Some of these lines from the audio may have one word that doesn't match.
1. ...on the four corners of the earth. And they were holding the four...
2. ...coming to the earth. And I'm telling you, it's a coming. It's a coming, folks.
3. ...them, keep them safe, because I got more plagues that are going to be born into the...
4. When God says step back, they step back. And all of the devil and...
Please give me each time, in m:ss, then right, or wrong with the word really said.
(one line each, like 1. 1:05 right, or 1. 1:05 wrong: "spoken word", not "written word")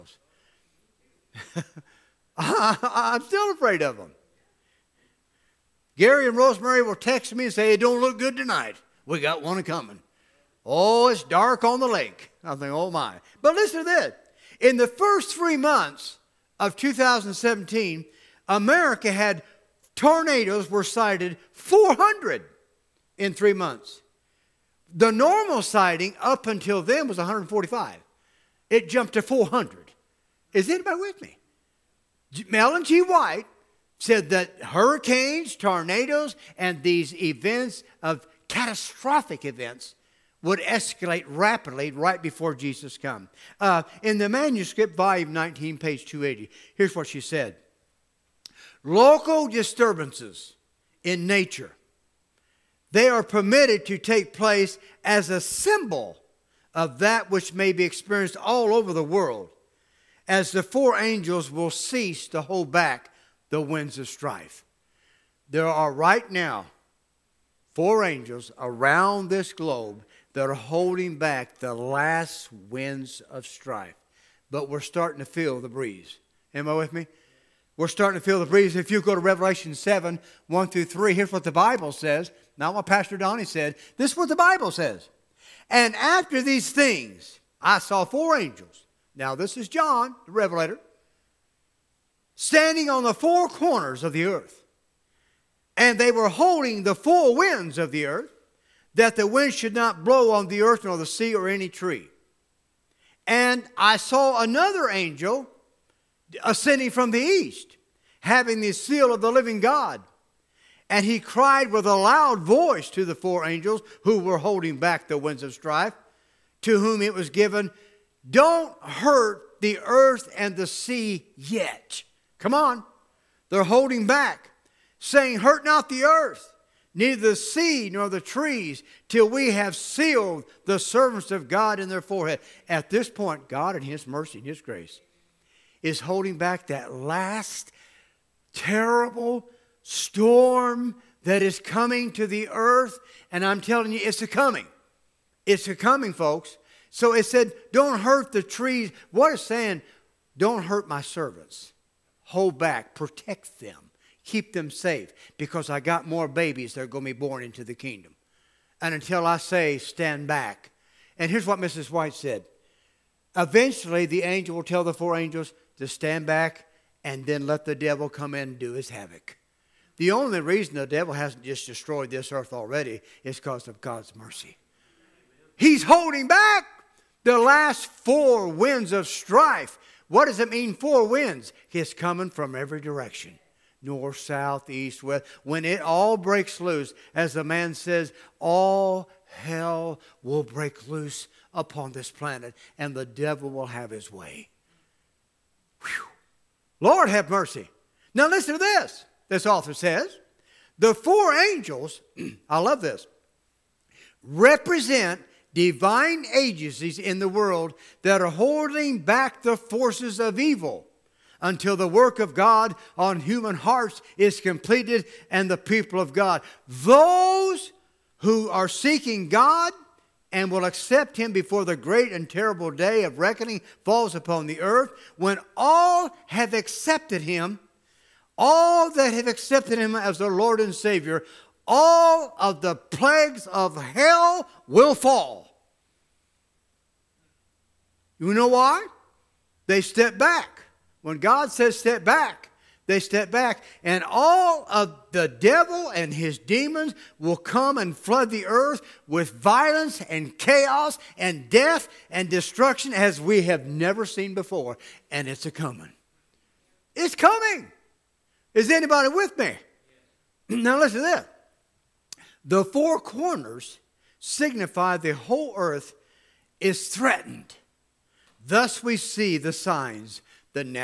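1. 1:32 right
2. 2:21 right
3. 2:33 wrong: "babies", not "plagues"
4. 4:01 right.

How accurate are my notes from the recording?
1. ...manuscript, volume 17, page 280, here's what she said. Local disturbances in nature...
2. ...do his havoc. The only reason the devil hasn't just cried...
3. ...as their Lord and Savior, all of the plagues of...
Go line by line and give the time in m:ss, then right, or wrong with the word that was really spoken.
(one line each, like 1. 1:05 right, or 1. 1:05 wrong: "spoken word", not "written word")
1. 0:44 wrong: "19", not "17"
2. 2:48 wrong: "destroyed", not "cried"
3. 3:49 right.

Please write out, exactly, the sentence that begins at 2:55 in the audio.
He's holding back the last four winds of strife what does it mean, four winds?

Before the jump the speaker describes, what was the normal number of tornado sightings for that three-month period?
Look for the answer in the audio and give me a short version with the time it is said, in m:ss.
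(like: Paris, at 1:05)
145, at 0:27.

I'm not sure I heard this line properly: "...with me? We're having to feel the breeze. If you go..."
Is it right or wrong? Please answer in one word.
wrong.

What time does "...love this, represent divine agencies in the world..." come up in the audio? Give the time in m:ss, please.
3:22.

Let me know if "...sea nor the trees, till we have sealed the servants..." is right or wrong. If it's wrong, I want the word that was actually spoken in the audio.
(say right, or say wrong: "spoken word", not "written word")
right.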